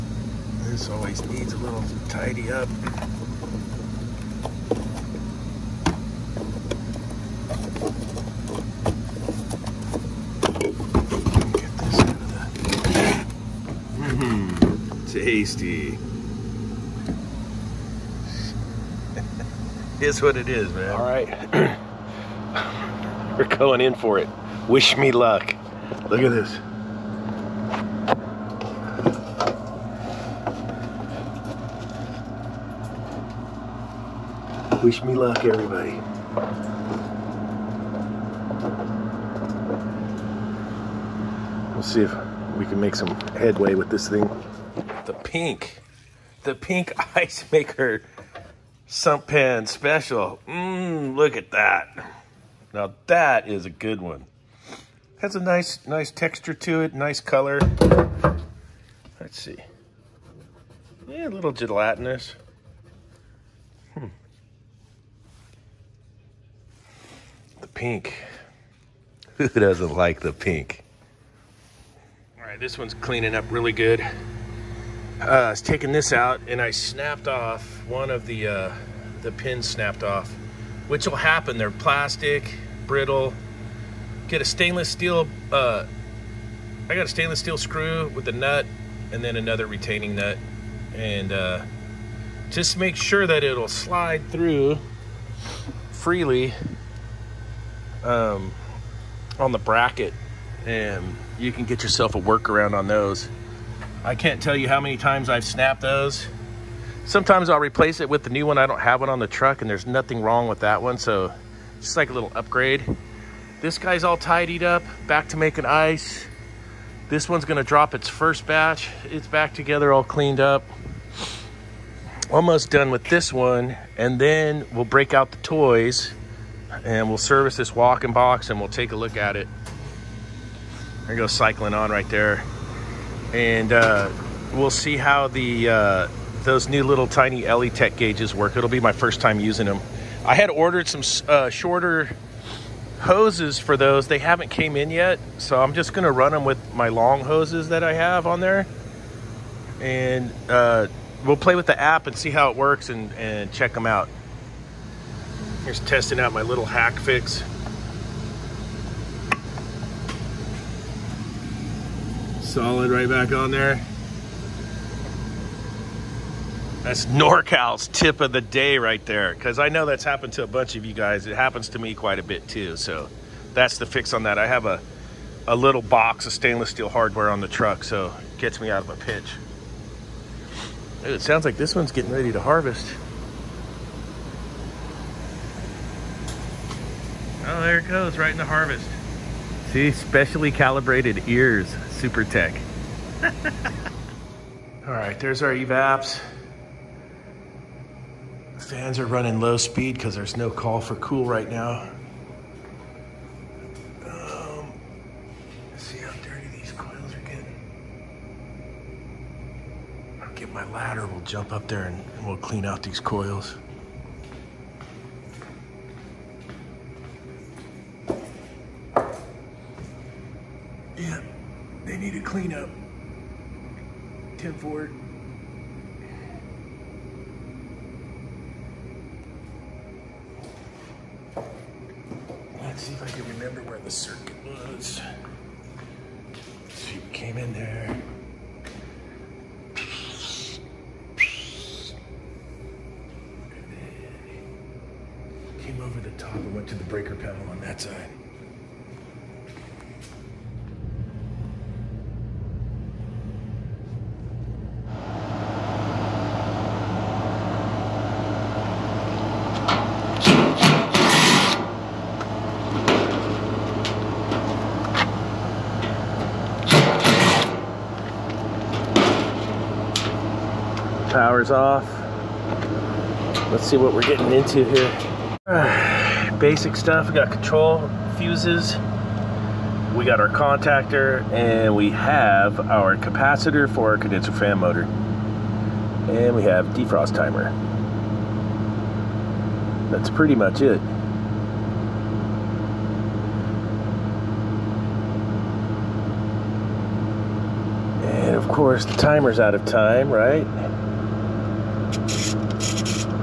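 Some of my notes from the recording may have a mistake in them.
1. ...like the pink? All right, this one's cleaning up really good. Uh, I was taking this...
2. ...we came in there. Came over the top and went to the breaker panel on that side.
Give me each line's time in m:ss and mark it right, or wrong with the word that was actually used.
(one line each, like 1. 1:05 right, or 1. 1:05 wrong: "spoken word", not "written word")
1. 1:09 right
2. 3:56 right.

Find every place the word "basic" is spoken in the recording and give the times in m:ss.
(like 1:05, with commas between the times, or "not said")
4:36.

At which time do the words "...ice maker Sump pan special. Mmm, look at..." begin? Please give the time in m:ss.
0:47.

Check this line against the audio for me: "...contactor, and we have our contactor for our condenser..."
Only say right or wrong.
wrong.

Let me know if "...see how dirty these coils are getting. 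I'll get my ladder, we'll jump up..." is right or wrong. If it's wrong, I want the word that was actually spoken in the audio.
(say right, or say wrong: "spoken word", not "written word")
right.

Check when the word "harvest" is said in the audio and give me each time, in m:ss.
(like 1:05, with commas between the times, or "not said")
3:02, 3:08.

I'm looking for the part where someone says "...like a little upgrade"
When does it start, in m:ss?
1:51.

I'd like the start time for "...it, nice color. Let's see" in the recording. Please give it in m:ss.
0:56.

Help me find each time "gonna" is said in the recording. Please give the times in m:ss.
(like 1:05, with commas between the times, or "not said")
1:57, 2:25.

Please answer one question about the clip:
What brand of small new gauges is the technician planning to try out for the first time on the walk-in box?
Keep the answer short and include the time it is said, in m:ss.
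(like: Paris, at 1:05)
Elitech, at 2:17.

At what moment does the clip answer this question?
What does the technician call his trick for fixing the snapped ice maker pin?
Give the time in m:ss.
2:47.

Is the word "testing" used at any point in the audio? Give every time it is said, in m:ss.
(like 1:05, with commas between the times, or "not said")
2:35.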